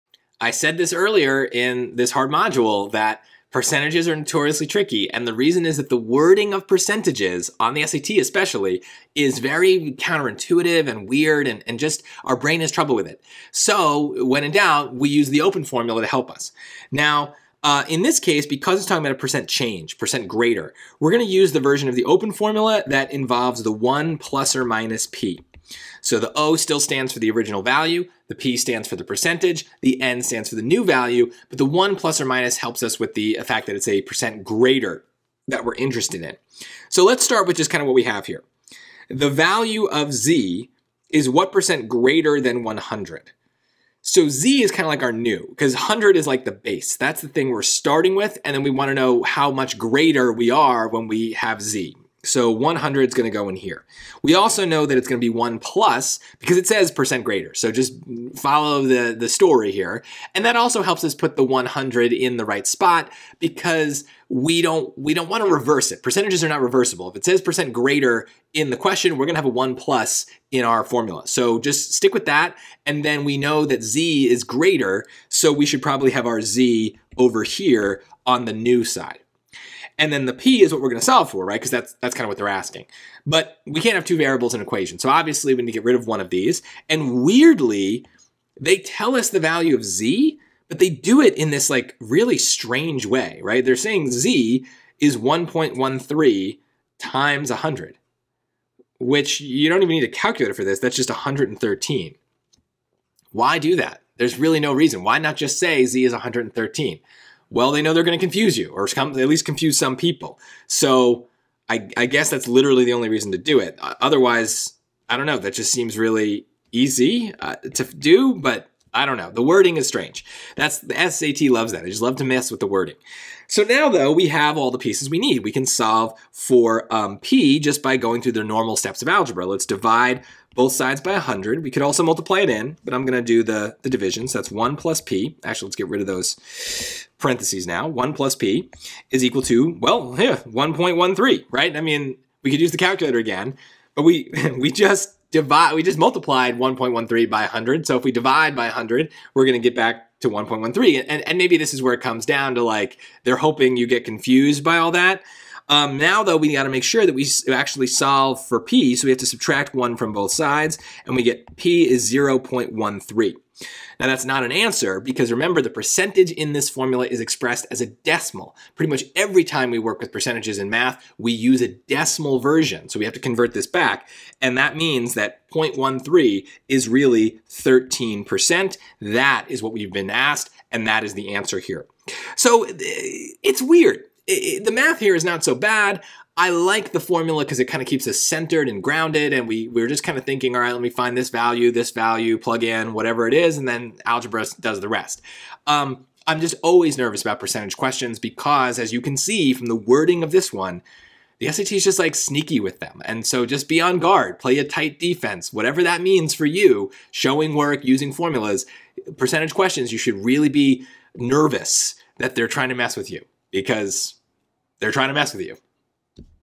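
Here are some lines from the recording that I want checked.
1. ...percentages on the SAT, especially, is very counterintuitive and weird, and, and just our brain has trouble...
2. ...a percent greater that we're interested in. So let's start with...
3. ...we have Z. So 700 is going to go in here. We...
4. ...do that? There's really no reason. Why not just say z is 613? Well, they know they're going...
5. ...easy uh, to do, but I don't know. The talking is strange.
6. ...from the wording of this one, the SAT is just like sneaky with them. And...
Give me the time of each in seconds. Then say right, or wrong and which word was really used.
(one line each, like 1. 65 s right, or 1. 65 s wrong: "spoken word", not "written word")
1. 6 s right
2. 33 s right
3. 51 s wrong: "100", not "700"
4. 103 s wrong: "113", not "613"
5. 116 s wrong: "wording", not "talking"
6. 199 s right.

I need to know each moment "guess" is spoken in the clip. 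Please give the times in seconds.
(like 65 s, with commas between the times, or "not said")
112 s.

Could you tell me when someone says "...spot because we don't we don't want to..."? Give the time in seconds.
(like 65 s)
62 s.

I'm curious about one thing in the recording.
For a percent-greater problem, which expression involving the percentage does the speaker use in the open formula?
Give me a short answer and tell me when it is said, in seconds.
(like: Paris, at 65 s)
1 plus or minus p, at 23 s.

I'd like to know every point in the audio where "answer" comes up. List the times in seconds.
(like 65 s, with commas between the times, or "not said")
164 s, 181 s.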